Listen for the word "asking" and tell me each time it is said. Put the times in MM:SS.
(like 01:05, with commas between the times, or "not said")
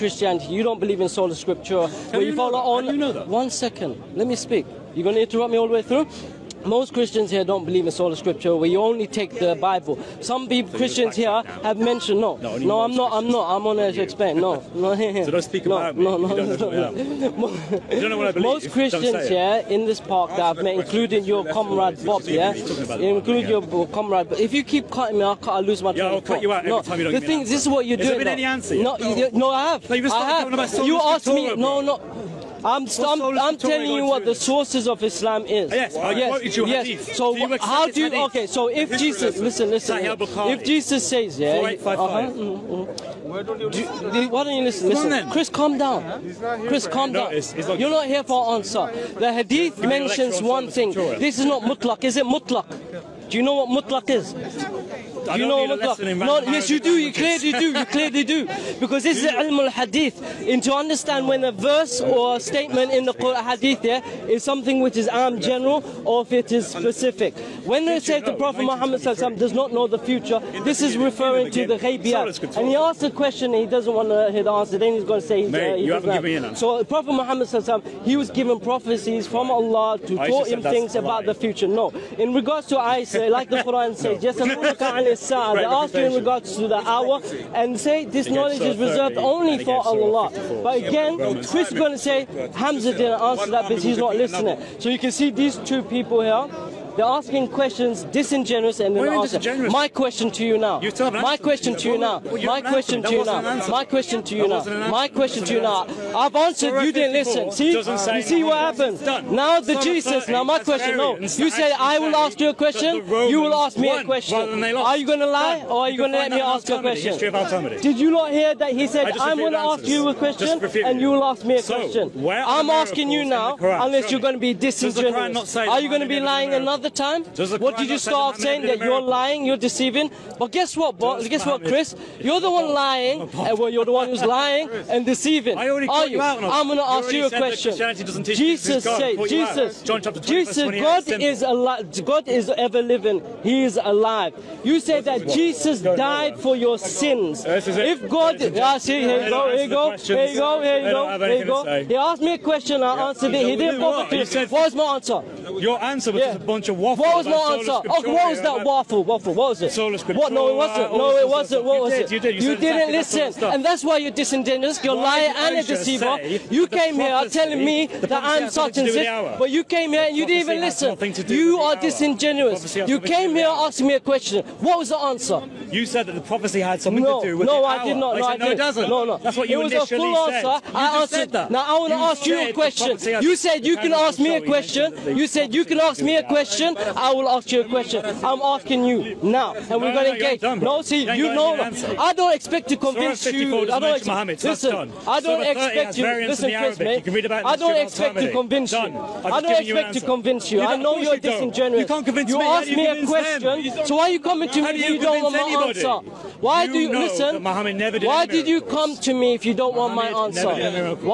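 01:37, 02:02, 02:53, 03:08.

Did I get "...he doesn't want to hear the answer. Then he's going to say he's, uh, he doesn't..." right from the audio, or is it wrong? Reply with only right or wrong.
right.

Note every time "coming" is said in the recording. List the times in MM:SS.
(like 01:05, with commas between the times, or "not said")
03:24.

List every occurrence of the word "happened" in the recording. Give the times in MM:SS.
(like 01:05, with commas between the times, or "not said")
01:48.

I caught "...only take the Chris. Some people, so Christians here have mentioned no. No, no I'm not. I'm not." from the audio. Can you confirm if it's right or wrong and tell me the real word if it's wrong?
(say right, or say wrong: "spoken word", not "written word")
wrong: "Bible", not "Chris".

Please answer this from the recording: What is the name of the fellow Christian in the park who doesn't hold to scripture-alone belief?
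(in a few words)
Bob.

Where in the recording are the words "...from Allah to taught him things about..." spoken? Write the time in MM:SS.
01:19.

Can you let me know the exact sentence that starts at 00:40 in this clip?
If Jesus says, yeah, uh -huh, mm, mm.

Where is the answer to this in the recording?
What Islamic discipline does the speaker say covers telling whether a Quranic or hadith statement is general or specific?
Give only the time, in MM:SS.
00:59.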